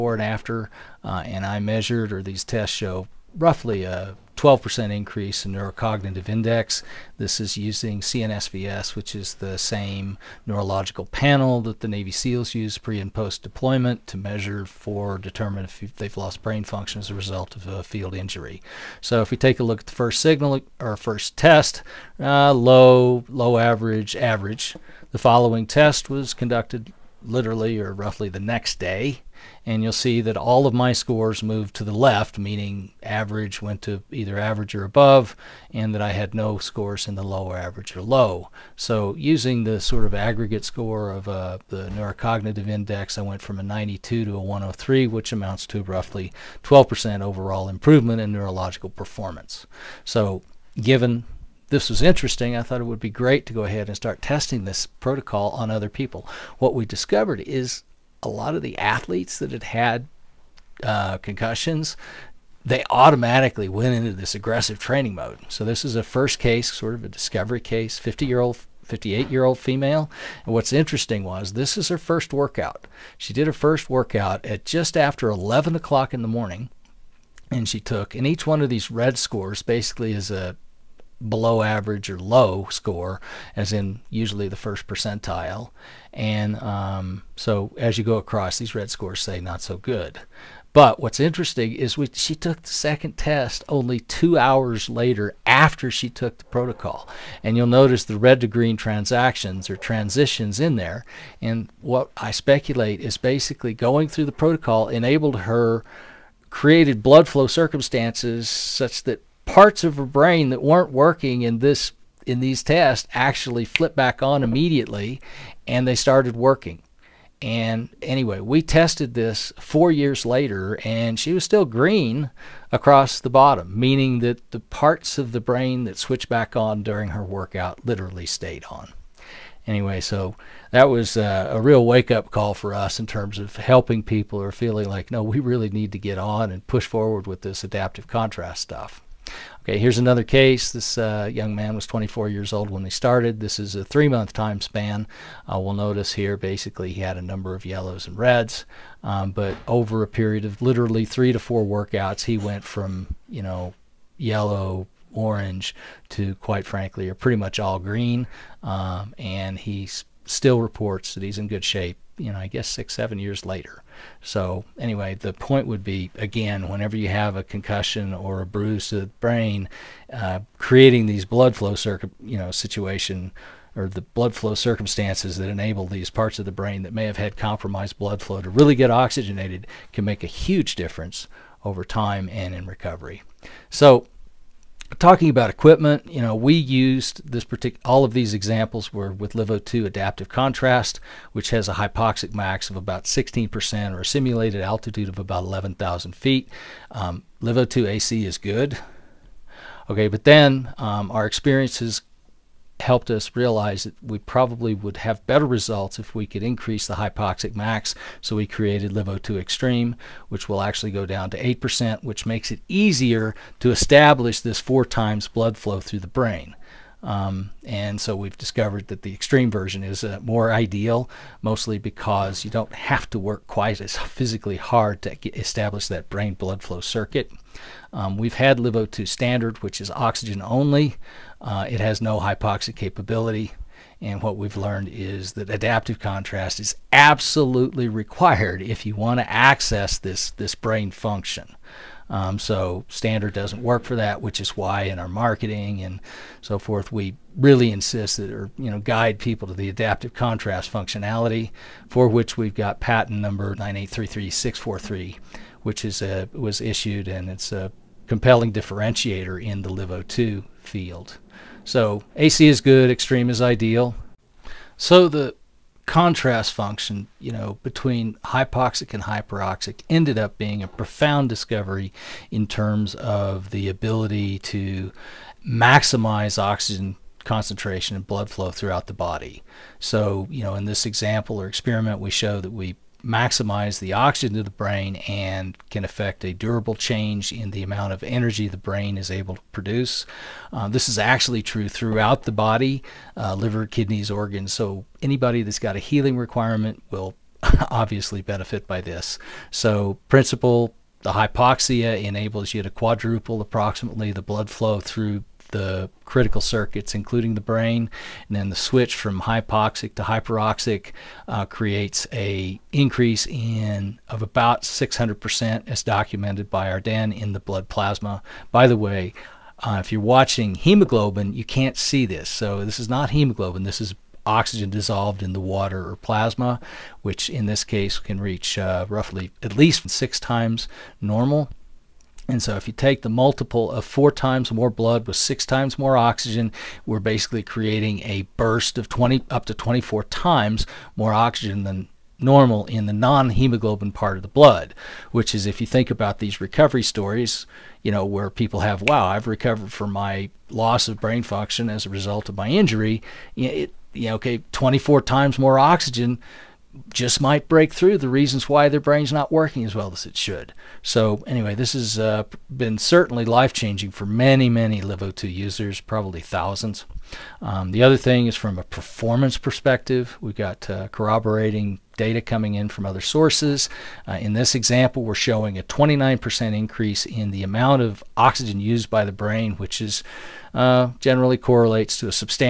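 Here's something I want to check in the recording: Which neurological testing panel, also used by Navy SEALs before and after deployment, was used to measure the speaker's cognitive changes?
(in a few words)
CNSVS.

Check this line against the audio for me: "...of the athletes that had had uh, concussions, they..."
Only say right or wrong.
right.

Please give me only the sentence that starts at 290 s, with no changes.
Uh, this is actually true throughout the body, uh, liver, kidneys, organs.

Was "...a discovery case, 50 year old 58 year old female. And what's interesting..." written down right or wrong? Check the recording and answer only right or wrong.
right.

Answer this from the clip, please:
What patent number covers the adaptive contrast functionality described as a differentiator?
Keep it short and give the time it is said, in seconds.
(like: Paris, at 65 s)
9833643, at 253 s.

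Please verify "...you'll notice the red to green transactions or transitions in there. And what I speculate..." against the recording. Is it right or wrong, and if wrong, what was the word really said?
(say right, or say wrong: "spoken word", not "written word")
right.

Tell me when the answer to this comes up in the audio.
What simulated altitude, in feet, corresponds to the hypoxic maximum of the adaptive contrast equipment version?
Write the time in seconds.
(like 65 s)
195 s.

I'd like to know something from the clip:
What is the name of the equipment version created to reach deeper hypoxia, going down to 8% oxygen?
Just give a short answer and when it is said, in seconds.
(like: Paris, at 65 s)
LiveO2 Extreme, at 208 s.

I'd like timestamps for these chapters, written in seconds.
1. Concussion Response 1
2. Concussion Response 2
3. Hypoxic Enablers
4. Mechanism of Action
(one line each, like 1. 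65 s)
1. 51 s
2. 137 s
3. 183 s
4. 263 s.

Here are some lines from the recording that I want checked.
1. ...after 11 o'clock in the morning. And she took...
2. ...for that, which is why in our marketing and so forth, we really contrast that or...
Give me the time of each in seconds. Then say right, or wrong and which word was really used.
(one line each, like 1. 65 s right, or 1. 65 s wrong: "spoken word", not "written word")
1. 74 s right
2. 243 s wrong: "insist", not "contrast".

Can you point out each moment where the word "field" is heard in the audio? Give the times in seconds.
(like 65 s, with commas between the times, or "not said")
17 s, 260 s.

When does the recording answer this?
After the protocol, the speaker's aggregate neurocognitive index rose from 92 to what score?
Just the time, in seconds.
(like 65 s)
44 s.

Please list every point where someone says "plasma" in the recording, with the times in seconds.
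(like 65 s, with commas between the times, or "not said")
317 s, 325 s.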